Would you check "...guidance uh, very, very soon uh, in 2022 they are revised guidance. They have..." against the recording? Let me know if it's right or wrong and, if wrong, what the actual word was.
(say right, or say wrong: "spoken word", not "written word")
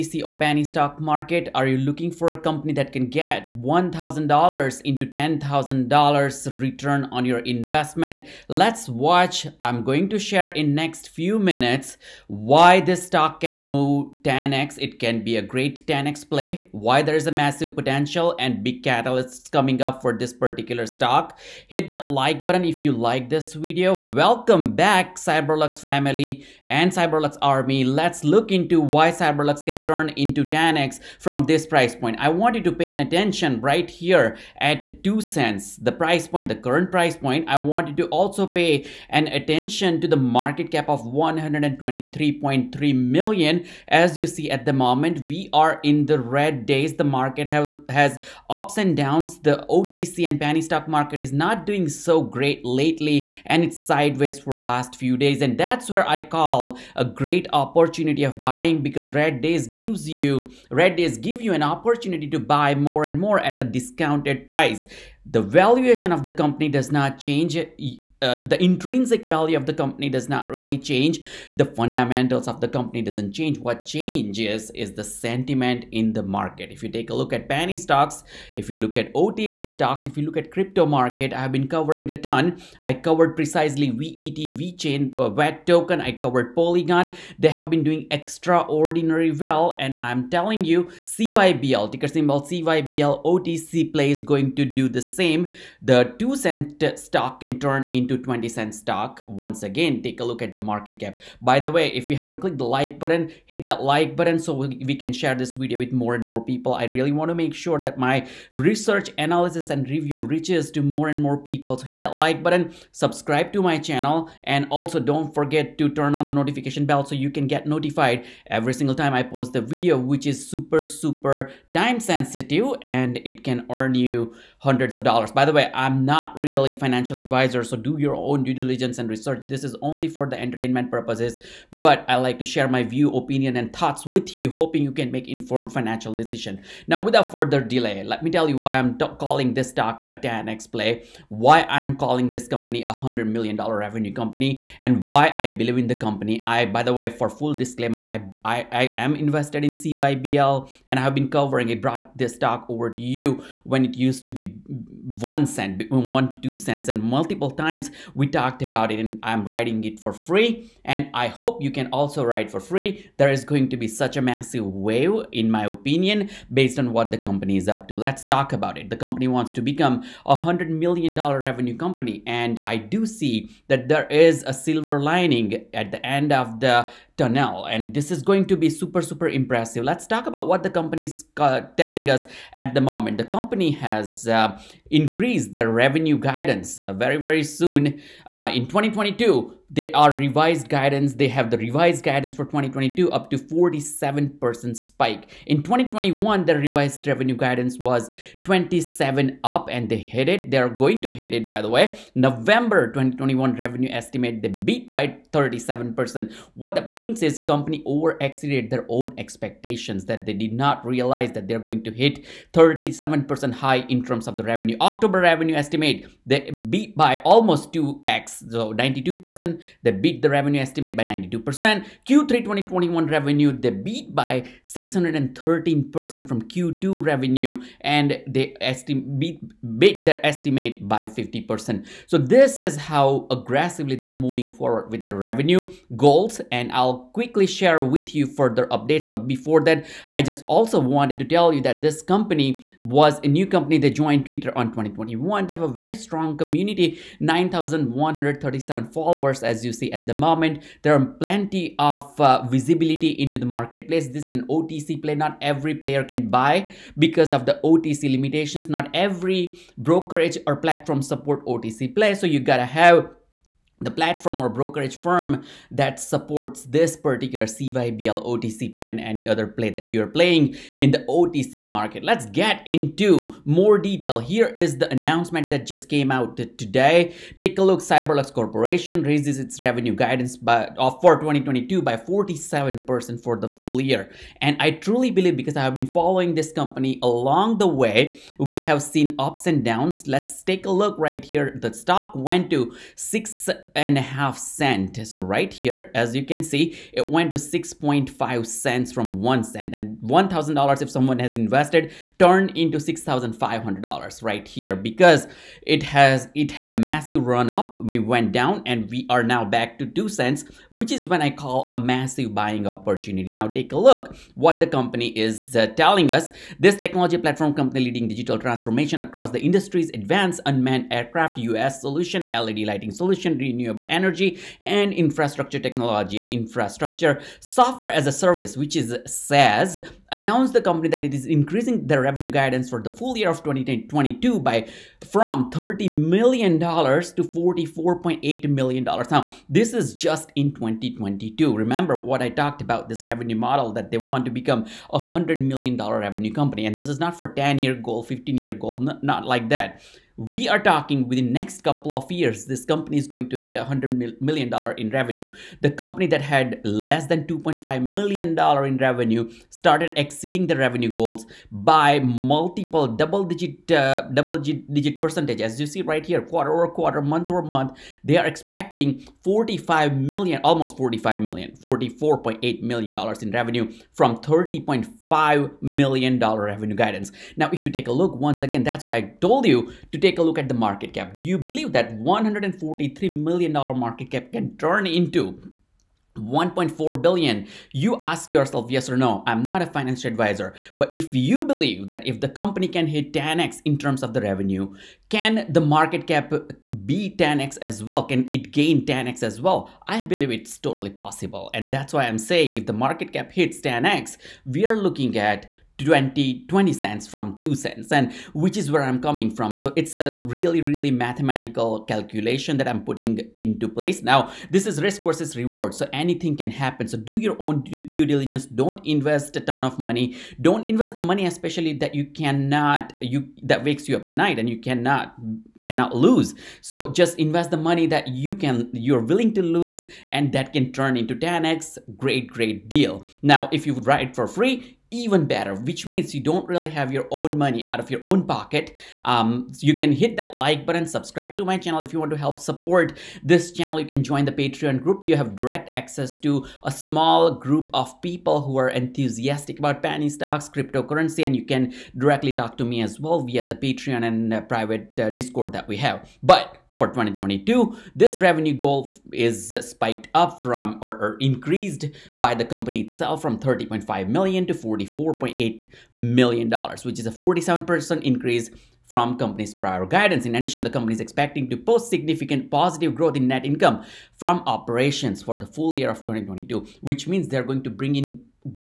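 right.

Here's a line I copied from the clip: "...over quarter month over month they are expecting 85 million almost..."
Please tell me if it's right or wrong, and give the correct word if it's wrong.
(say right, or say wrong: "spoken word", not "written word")
wrong: "45", not "85".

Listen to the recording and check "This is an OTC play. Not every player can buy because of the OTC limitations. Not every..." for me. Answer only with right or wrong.
right.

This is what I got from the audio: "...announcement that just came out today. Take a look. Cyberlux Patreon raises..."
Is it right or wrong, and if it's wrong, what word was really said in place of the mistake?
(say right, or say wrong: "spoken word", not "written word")
wrong: "Corporation", not "Patreon".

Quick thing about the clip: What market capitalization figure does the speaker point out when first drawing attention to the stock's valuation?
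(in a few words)
123.3 million.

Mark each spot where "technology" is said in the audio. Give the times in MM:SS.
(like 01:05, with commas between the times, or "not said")
05:16, 05:25.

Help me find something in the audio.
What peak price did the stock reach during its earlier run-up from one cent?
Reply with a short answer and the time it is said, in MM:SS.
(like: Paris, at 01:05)
6.5 cents, at 04:57.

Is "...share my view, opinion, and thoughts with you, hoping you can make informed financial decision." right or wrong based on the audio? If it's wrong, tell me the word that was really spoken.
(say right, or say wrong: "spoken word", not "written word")
right.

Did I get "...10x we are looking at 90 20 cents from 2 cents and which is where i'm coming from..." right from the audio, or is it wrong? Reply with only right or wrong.
wrong.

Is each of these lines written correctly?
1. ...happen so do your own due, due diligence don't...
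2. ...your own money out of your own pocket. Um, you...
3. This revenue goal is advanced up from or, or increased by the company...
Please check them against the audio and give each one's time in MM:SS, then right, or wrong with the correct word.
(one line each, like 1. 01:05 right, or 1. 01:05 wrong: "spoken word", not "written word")
1. 06:56 right
2. 07:16 right
3. 07:37 wrong: "spiked", not "advanced".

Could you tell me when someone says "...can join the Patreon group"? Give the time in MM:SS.
07:23.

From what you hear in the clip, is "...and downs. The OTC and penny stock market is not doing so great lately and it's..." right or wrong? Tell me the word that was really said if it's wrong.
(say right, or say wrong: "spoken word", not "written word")
right.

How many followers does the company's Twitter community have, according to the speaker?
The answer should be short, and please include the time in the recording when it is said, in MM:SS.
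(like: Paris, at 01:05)
9,137, at 04:07.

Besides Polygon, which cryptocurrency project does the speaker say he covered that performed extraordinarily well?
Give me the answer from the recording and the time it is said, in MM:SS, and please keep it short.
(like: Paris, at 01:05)
VeChain, at 01:24.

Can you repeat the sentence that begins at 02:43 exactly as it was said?
There is going to be such a massive wave, in my opinion, based on what the company is up to.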